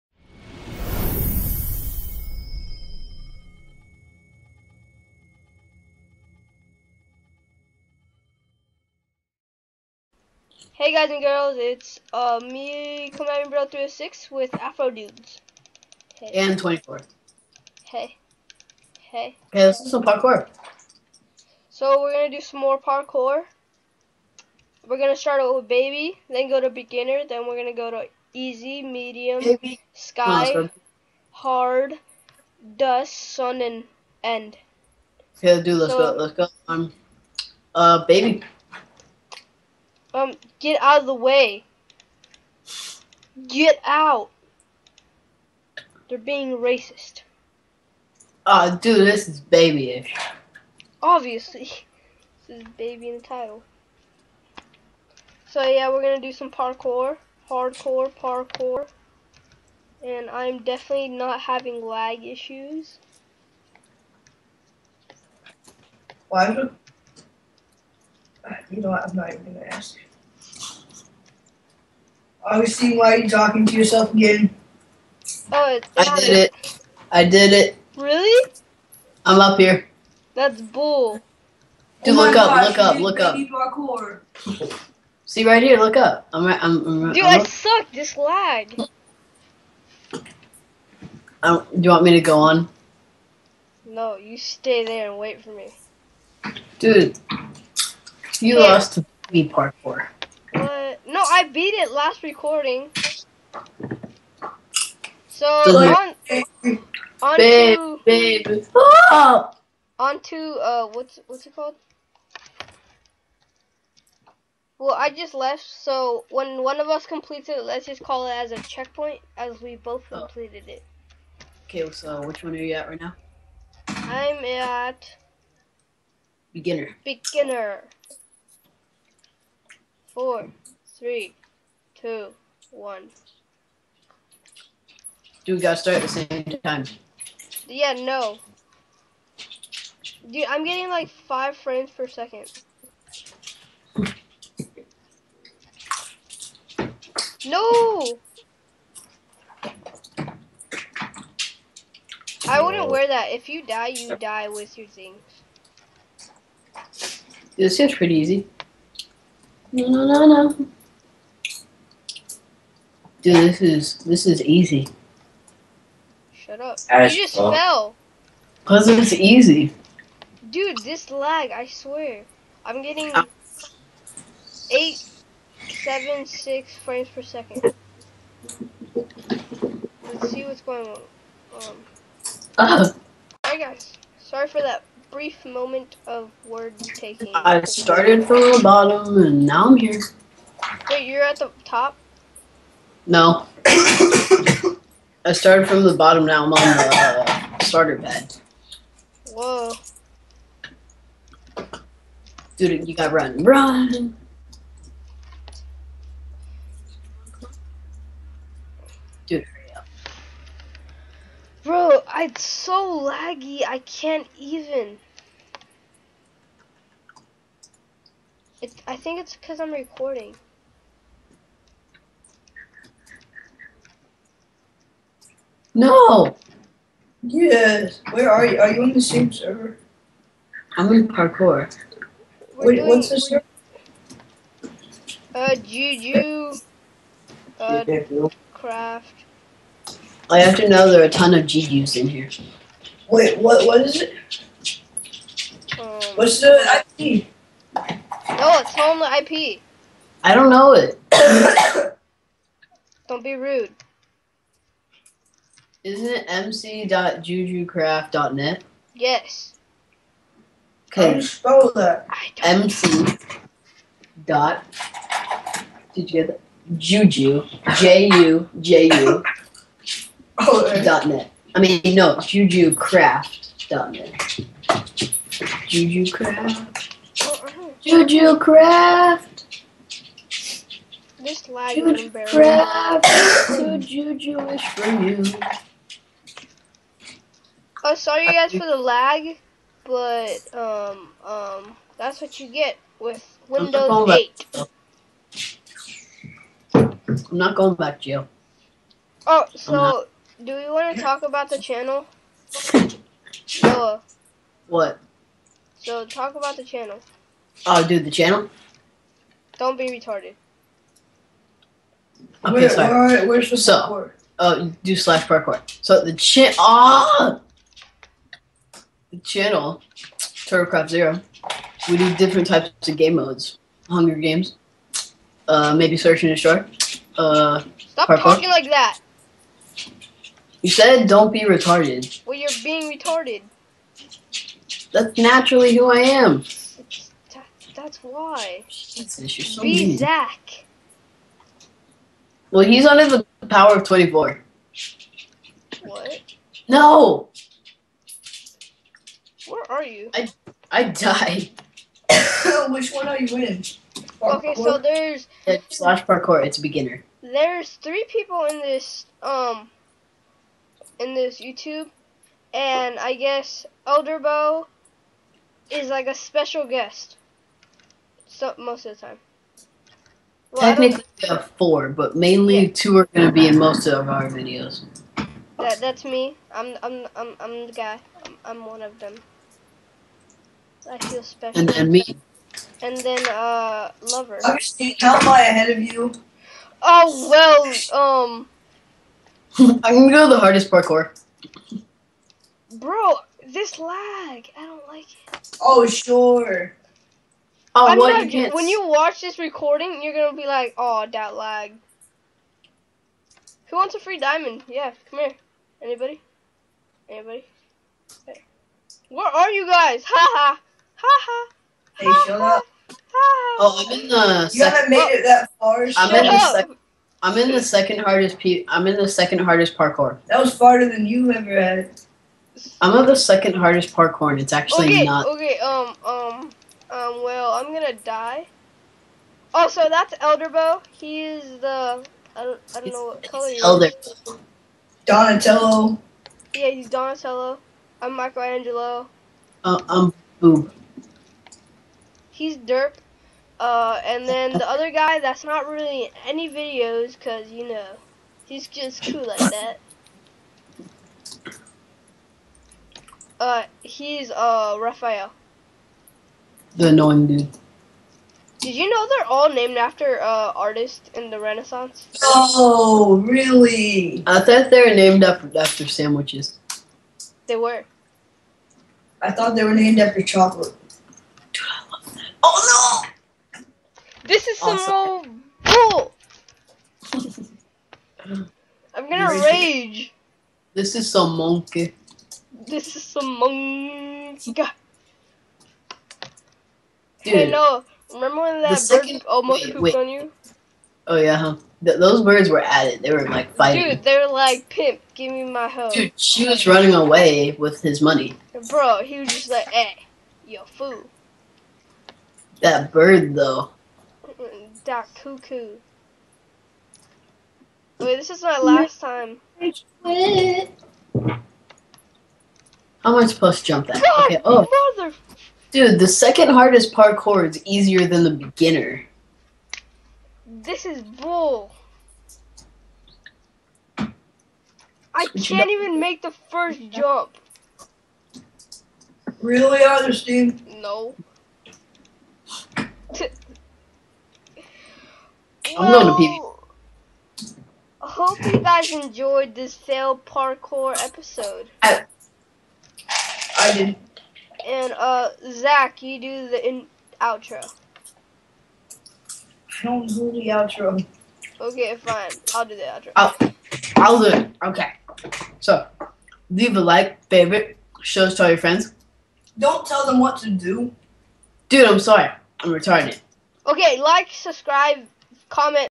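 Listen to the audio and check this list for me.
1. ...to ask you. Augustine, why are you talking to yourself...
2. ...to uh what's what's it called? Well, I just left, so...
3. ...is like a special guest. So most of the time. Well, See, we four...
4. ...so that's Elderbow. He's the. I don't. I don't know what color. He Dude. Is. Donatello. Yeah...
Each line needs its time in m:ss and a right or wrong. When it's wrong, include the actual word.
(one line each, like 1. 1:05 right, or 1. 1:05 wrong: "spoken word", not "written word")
1. 1:09 right
2. 1:50 right
3. 6:05 wrong: "Technically", not "See"
4. 7:09 wrong: "Elder", not "Dude".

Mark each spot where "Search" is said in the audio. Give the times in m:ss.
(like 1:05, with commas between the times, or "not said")
5:25.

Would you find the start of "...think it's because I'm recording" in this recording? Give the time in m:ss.
3:38.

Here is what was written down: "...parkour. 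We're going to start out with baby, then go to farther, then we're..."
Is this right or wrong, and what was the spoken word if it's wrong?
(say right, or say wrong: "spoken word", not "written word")
wrong: "beginner", not "farther".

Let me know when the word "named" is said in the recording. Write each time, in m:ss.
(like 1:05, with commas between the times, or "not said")
7:39, 7:44, 7:49.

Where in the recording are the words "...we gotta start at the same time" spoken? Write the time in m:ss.
2:15.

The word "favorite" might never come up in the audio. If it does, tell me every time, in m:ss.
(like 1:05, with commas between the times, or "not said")
9:17.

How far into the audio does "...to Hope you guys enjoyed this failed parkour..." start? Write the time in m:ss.
8:57.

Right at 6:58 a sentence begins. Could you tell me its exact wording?
Pe- I'm in the second hardest parkour.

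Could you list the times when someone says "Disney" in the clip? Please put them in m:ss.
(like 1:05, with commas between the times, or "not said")
not said.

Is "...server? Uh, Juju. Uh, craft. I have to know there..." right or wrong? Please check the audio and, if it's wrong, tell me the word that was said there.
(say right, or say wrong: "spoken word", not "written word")
right.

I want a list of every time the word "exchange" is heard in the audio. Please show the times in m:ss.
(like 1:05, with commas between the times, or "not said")
not said.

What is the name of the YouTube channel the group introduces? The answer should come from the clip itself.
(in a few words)
TurtleCrew Zero.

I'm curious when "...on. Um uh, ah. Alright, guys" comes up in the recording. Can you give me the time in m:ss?
3:00.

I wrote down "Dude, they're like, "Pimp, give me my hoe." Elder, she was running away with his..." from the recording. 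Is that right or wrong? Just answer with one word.
wrong.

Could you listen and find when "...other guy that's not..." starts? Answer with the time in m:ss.
7:24.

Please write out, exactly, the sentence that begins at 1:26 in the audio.
I'm right, I'm, I'm, Dude, I'm i suck.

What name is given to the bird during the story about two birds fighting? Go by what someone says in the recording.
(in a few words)
Doc Cuckoo.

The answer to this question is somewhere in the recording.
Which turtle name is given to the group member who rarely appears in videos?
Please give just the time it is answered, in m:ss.
7:34.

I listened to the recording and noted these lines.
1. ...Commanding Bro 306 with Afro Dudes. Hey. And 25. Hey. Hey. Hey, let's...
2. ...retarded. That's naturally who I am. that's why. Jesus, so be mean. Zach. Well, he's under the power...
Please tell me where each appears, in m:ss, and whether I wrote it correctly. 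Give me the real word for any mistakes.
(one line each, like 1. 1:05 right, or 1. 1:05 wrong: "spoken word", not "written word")
1. 0:13 wrong: "24", not "25"
2. 5:32 right.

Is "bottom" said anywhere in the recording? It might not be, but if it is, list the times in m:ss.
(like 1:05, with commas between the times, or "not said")
3:08, 3:15.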